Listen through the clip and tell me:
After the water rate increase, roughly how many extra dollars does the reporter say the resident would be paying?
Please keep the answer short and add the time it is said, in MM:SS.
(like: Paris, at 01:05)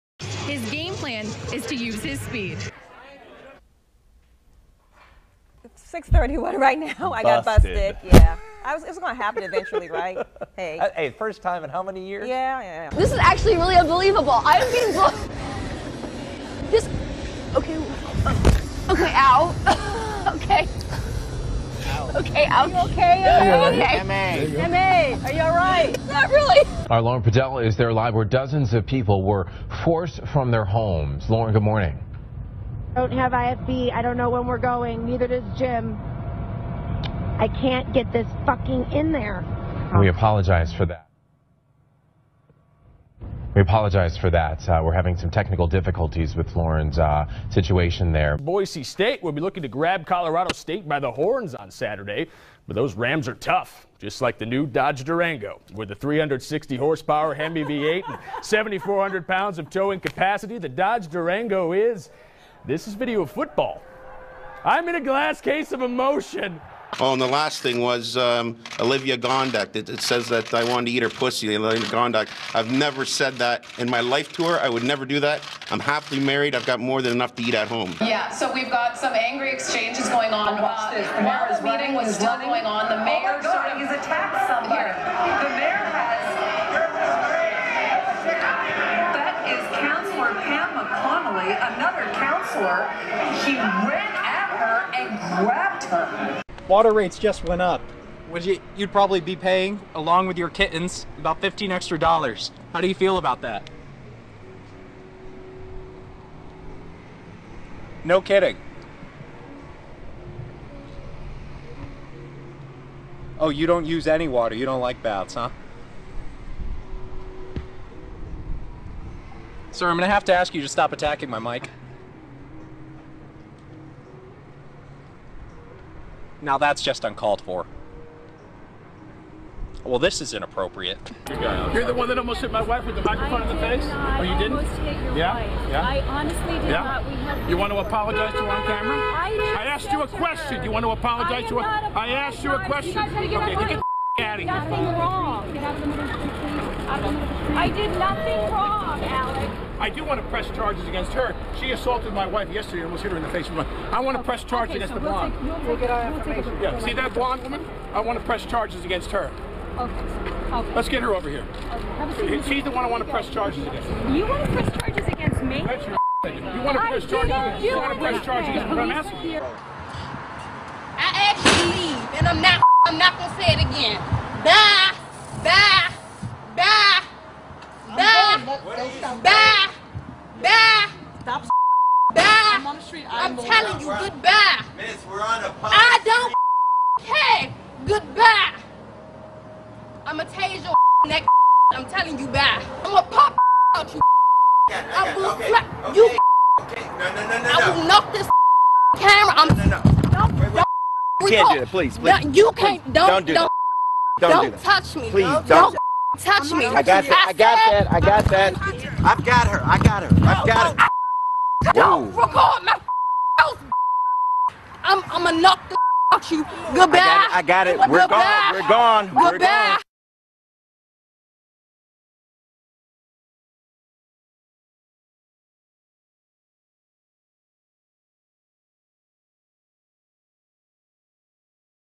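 15, at 01:41.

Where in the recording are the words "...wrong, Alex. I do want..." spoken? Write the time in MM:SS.
02:28.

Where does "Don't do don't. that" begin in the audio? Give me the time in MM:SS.
03:23.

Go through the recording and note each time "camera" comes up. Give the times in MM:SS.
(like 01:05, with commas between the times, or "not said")
02:18, 03:18.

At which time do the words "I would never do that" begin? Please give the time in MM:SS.
01:14.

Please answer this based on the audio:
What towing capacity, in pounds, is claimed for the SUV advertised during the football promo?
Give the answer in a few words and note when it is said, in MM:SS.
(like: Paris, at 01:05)
7,400 pounds, at 00:58.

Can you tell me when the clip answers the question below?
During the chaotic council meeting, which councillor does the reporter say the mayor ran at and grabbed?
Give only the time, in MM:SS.
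01:30.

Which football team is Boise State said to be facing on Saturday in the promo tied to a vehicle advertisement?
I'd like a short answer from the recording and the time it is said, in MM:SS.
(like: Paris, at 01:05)
Colorado State, at 00:50.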